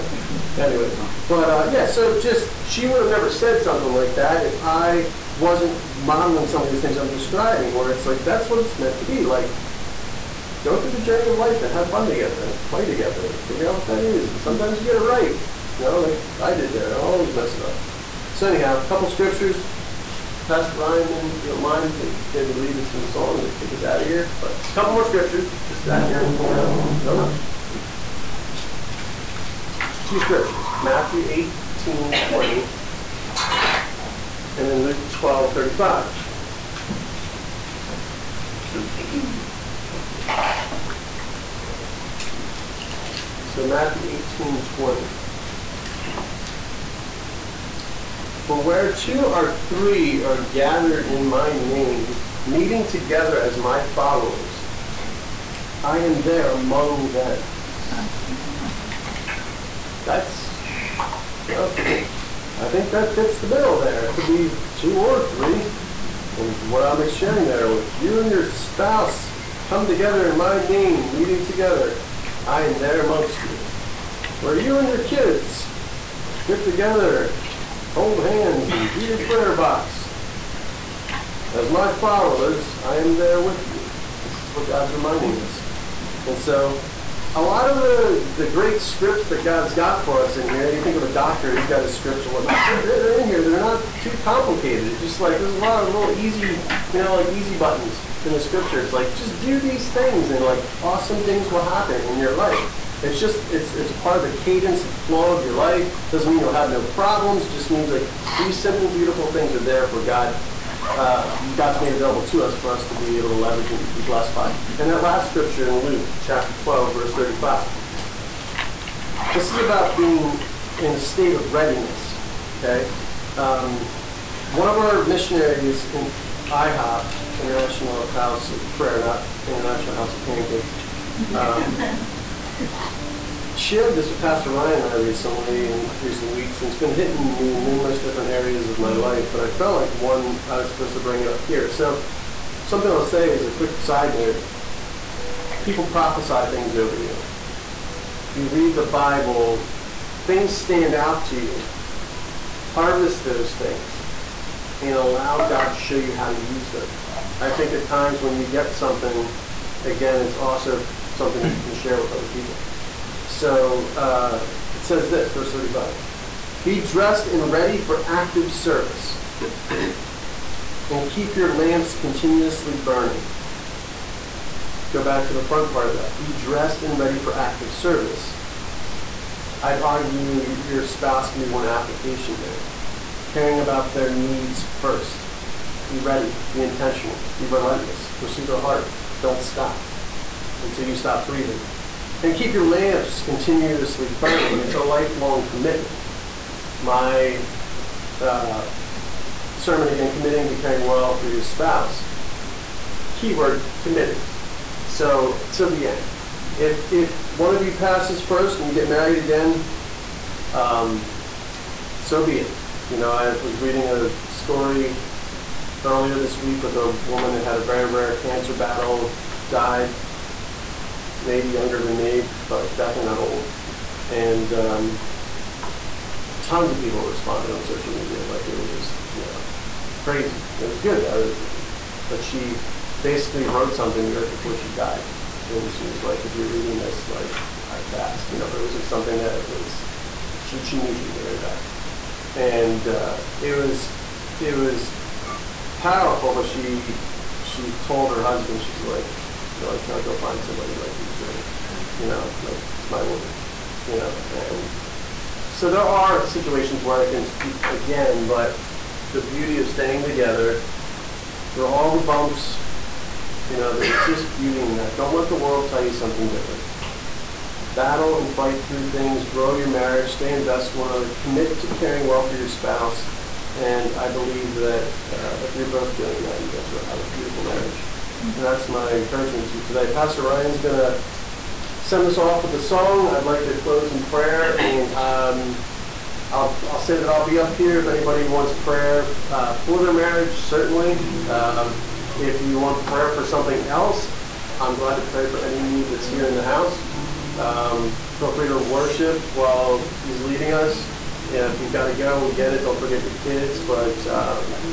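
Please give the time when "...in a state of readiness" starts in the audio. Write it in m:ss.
2:00.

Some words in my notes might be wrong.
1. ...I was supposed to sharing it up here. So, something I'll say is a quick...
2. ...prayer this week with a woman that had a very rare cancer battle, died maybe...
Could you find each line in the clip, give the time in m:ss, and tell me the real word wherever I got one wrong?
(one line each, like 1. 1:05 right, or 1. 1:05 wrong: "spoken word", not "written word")
1. 2:20 wrong: "bring", not "sharing"
2. 3:35 wrong: "earlier", not "prayer".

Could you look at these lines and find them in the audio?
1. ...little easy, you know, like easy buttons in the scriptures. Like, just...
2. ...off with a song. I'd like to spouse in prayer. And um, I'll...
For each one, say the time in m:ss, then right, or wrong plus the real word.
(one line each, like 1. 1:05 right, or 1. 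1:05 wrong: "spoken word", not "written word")
1. 1:35 right
2. 4:42 wrong: "close", not "spouse".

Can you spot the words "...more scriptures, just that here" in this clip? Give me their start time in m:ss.
0:24.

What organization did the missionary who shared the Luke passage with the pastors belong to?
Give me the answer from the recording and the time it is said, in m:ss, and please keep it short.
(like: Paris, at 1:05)
International House of Prayer, at 2:07.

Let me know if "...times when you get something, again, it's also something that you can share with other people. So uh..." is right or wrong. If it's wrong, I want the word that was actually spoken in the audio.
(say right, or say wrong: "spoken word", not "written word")
right.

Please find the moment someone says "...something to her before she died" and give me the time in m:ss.
3:53.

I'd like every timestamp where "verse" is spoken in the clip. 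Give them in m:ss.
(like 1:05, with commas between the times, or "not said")
1:56, 2:45.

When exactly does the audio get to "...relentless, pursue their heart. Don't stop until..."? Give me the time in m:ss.
3:07.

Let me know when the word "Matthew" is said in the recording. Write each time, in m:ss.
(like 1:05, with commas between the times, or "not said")
0:30, 0:43.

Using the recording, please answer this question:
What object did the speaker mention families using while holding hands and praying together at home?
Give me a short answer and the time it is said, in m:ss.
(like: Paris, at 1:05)
A prayer box, at 1:19.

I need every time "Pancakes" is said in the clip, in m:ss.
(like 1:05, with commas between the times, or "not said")
2:10.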